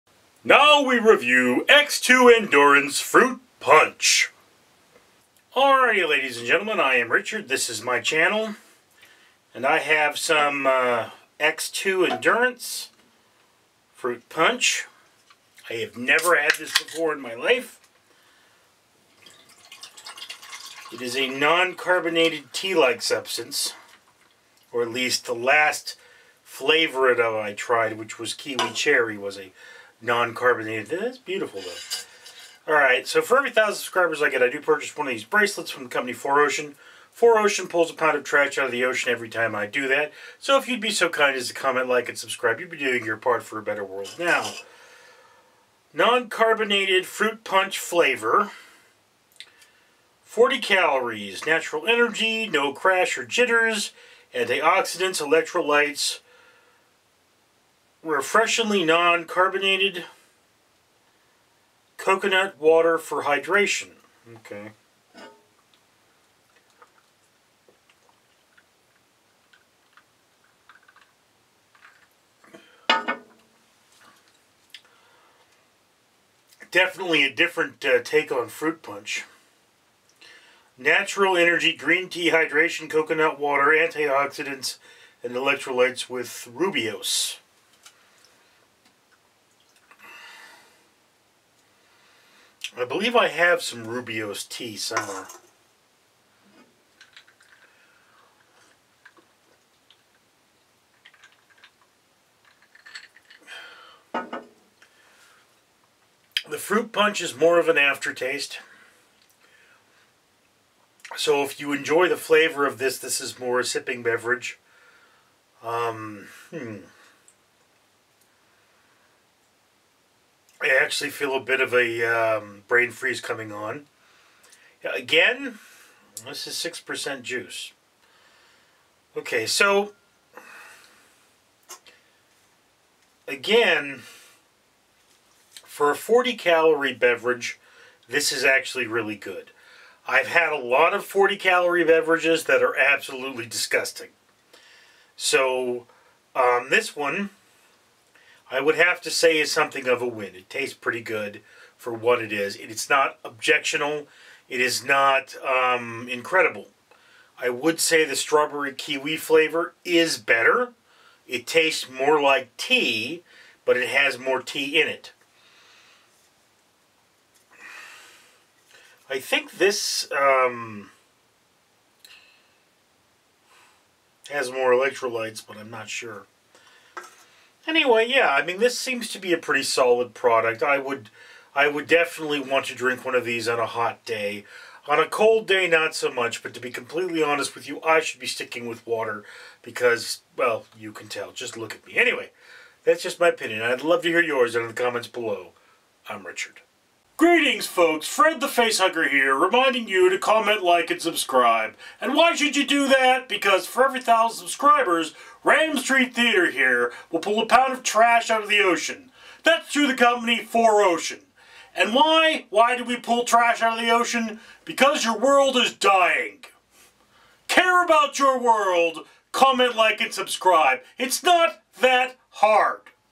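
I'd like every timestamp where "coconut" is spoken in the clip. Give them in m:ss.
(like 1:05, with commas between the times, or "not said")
1:01, 1:22.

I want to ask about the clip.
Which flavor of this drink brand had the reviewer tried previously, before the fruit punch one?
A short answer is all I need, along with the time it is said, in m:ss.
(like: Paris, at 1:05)
kiwi cherry, at 0:28.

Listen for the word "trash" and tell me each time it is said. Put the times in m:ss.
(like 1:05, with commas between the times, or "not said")
0:38, 3:27, 3:33.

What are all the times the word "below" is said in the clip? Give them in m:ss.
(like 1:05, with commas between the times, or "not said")
3:15.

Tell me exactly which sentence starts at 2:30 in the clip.
It tastes pretty good for what it is.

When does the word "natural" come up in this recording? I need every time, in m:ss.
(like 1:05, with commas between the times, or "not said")
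0:51, 1:20.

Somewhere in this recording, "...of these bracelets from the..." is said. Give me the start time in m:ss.
0:35.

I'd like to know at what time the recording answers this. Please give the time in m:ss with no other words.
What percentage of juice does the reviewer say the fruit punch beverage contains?
2:06.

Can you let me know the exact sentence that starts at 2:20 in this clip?
I've had a lot of 40 calorie beverages that are absolutely disgusting.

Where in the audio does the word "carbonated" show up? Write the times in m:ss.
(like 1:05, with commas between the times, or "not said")
0:21, 0:30, 0:45, 0:58.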